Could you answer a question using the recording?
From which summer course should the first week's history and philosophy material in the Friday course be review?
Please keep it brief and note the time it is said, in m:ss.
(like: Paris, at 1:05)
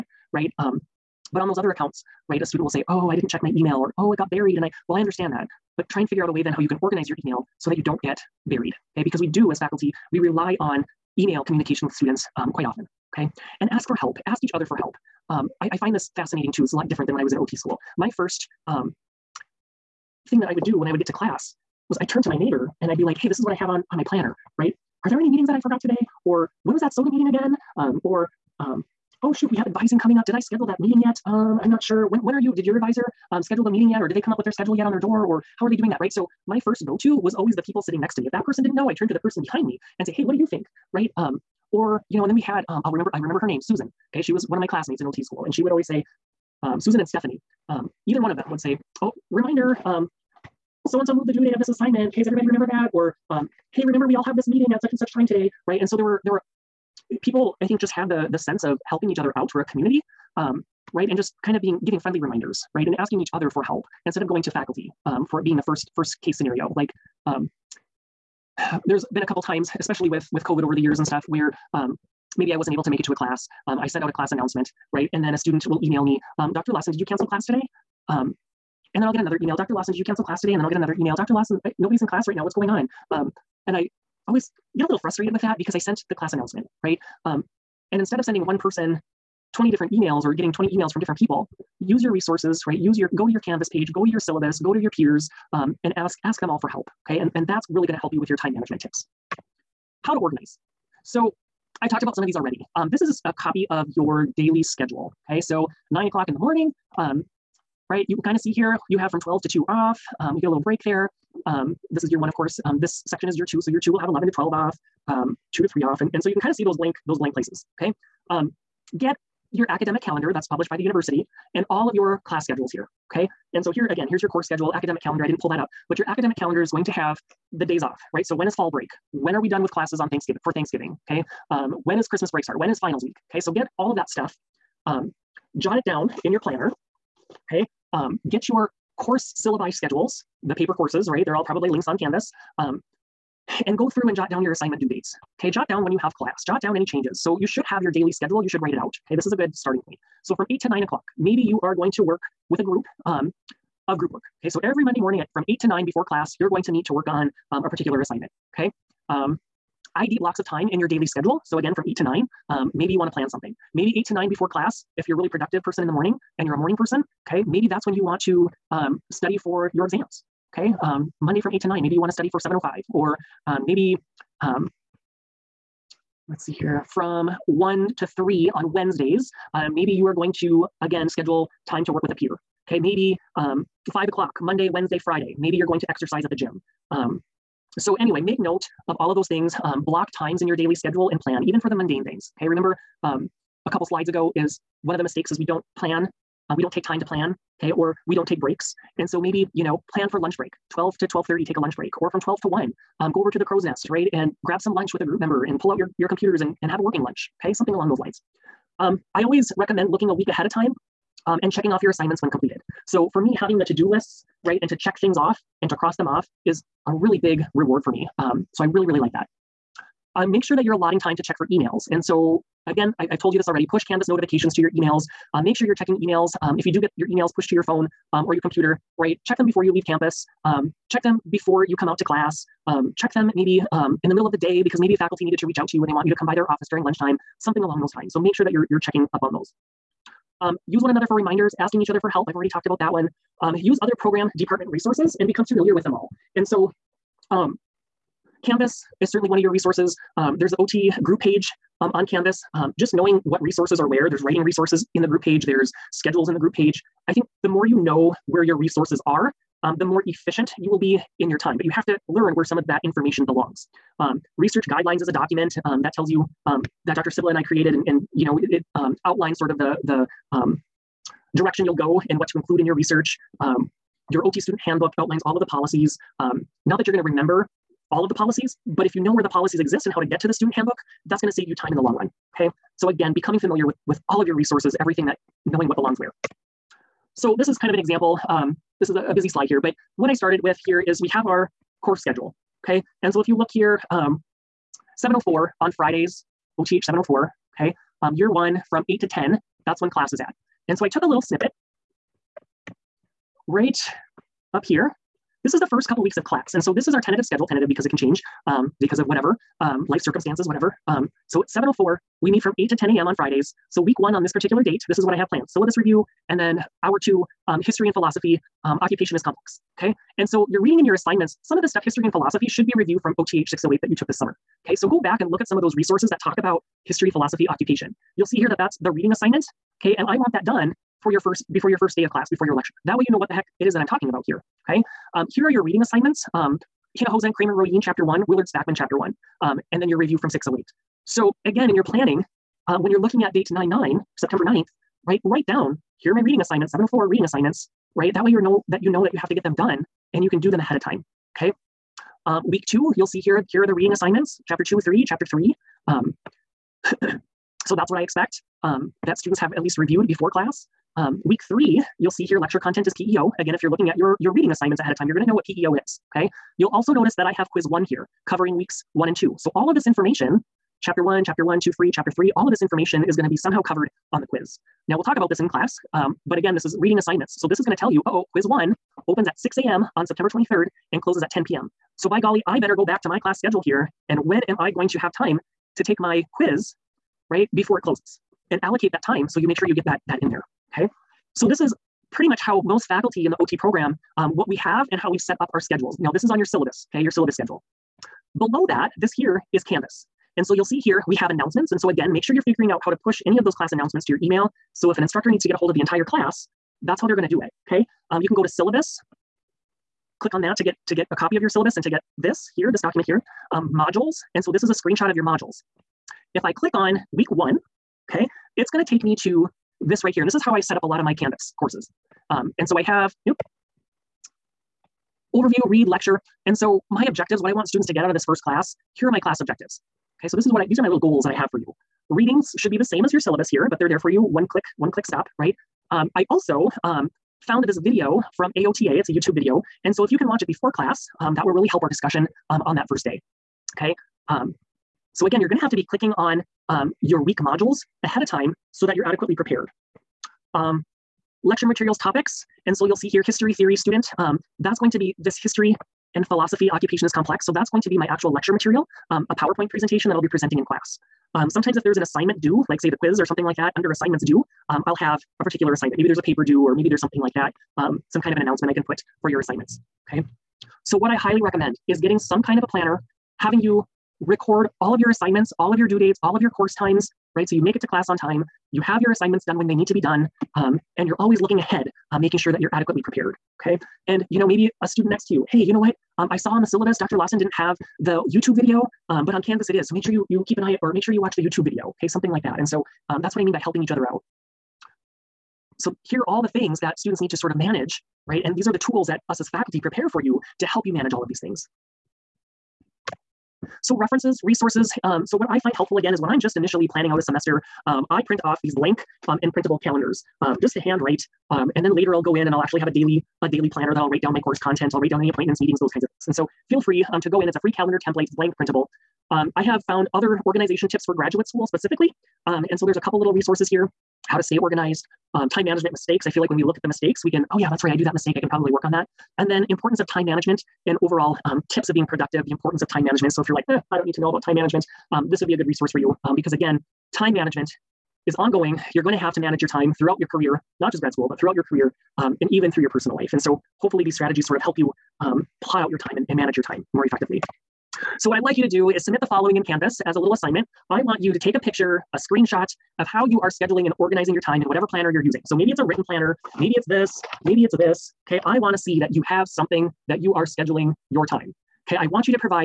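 OTH 608, at 5:23.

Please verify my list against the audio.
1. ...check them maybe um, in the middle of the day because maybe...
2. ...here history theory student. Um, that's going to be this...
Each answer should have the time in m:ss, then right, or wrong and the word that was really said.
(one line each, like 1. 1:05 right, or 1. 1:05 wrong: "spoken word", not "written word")
1. 3:52 right
2. 7:33 right.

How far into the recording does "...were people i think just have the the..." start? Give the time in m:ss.
0:56.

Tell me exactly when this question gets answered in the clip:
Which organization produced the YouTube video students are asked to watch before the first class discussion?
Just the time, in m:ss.
7:18.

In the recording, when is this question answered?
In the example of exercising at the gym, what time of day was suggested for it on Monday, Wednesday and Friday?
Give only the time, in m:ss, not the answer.
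3:03.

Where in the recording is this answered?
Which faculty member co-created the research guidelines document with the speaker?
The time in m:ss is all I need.
4:26.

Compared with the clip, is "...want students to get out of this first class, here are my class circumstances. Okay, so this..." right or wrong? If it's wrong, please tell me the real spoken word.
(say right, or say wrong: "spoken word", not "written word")
wrong: "objectives", not "circumstances".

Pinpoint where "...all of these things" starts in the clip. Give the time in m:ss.
8:21.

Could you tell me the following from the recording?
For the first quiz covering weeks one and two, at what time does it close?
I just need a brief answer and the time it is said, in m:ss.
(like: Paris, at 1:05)
10 p.m., at 6:21.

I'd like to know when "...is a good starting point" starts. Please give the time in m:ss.
2:29.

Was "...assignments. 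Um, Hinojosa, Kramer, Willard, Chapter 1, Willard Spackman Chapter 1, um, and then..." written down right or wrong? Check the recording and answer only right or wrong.
wrong.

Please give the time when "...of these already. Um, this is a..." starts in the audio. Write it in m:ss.
1:42.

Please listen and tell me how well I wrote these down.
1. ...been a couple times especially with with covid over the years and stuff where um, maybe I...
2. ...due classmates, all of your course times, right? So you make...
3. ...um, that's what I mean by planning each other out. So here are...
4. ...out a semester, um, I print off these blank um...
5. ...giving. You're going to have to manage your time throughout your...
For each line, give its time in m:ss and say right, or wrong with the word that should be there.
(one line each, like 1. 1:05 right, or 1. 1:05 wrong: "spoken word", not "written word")
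1. 1:09 right
2. 7:55 wrong: "dates", not "classmates"
3. 8:13 wrong: "helping", not "planning"
4. 8:27 right
5. 8:58 wrong: "ongoing", not "giving".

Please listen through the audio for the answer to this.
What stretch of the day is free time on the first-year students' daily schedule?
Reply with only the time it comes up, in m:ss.
1:49.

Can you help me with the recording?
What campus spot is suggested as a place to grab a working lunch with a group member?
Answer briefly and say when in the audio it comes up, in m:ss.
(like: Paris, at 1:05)
the crow's nest, at 3:23.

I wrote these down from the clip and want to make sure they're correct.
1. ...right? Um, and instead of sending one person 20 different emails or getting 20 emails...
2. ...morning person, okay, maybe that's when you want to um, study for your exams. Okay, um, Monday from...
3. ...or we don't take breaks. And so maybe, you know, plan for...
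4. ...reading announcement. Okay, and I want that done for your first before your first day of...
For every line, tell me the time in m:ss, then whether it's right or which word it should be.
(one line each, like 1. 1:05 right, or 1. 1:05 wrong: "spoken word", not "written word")
1. 1:26 right
2. 2:46 right
3. 3:17 right
4. 5:28 wrong: "assignment", not "announcement".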